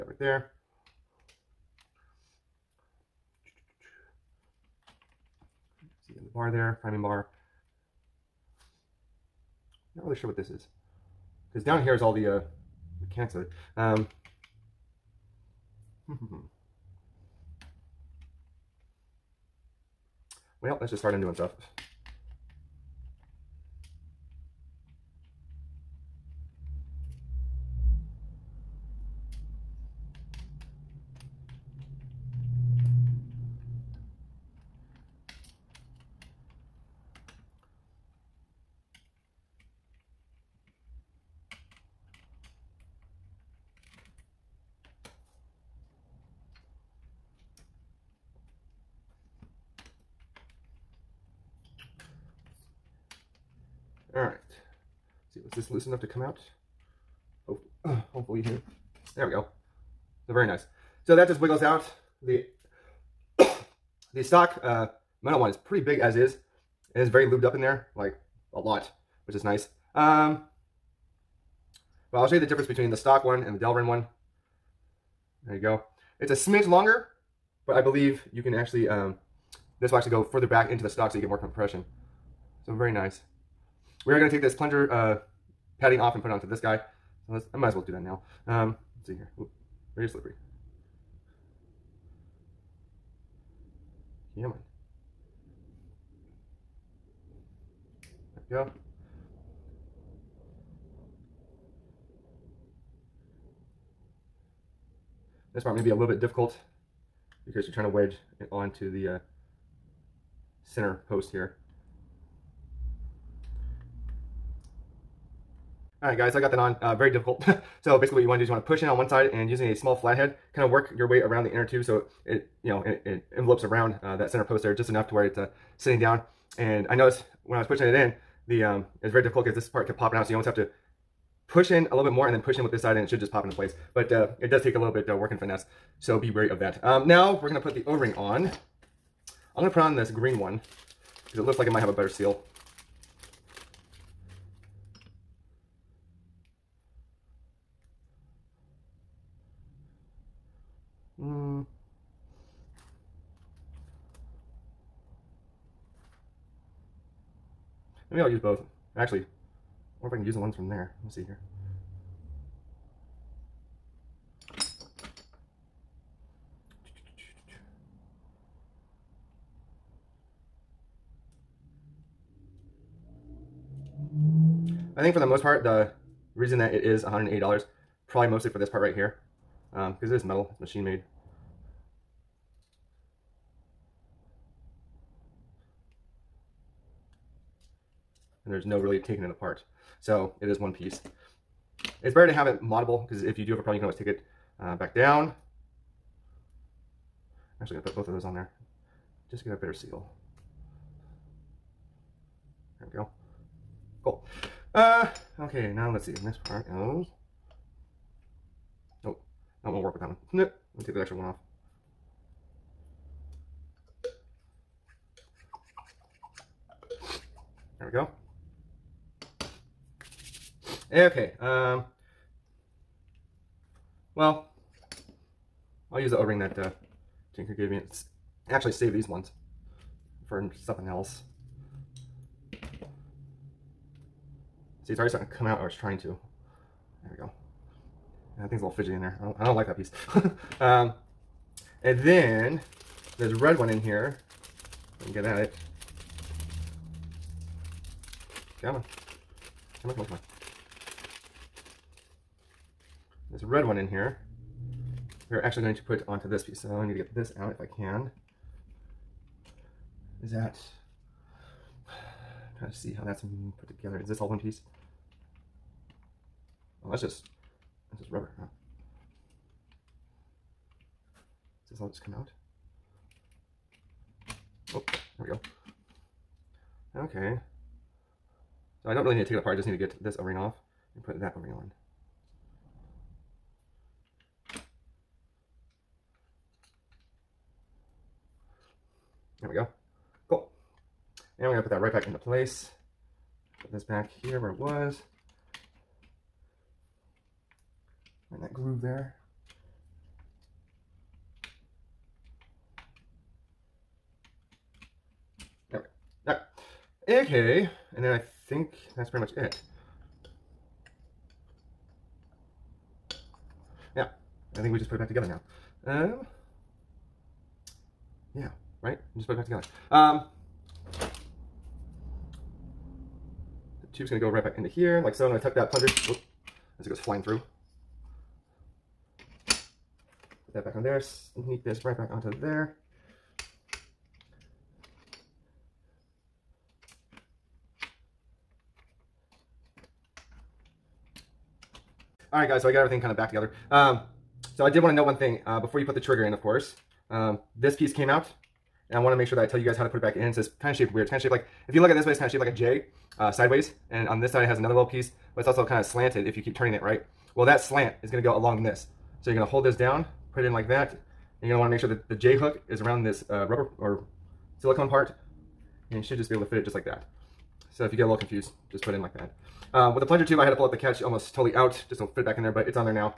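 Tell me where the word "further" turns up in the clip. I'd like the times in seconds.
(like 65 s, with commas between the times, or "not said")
80 s.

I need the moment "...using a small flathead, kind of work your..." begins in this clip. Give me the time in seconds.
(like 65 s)
119 s.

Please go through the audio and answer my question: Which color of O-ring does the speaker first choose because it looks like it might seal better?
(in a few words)
Green.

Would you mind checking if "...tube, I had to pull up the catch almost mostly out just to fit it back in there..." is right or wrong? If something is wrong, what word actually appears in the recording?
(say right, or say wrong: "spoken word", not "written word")
wrong: "totally", not "mostly".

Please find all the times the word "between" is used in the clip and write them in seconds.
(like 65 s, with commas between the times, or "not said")
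72 s.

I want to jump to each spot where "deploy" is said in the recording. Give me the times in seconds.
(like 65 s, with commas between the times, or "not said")
not said.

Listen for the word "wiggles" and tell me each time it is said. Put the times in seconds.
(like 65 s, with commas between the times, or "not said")
61 s.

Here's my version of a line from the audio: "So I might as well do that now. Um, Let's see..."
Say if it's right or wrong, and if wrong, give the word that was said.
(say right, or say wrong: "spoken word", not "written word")
right.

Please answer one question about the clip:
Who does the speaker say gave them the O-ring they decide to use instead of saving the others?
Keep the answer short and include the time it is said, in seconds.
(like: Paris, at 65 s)
Tinker, at 227 s.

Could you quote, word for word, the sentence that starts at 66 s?
It is very lubed up in there, like a lot, which is nice.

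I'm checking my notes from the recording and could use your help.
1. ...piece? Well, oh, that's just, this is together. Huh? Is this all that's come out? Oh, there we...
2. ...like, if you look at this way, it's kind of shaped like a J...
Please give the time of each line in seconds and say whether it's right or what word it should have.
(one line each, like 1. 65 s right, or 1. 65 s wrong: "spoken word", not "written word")
1. 264 s wrong: "rubber", not "together"
2. 351 s right.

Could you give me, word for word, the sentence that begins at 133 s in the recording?
But uh, it does take a little bit uh, work and finesse.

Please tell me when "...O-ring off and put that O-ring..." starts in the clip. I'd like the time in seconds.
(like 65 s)
280 s.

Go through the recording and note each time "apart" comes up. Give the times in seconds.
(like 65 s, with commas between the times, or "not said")
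189 s, 279 s.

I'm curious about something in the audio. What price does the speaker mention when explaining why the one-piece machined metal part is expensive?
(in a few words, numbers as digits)
$180.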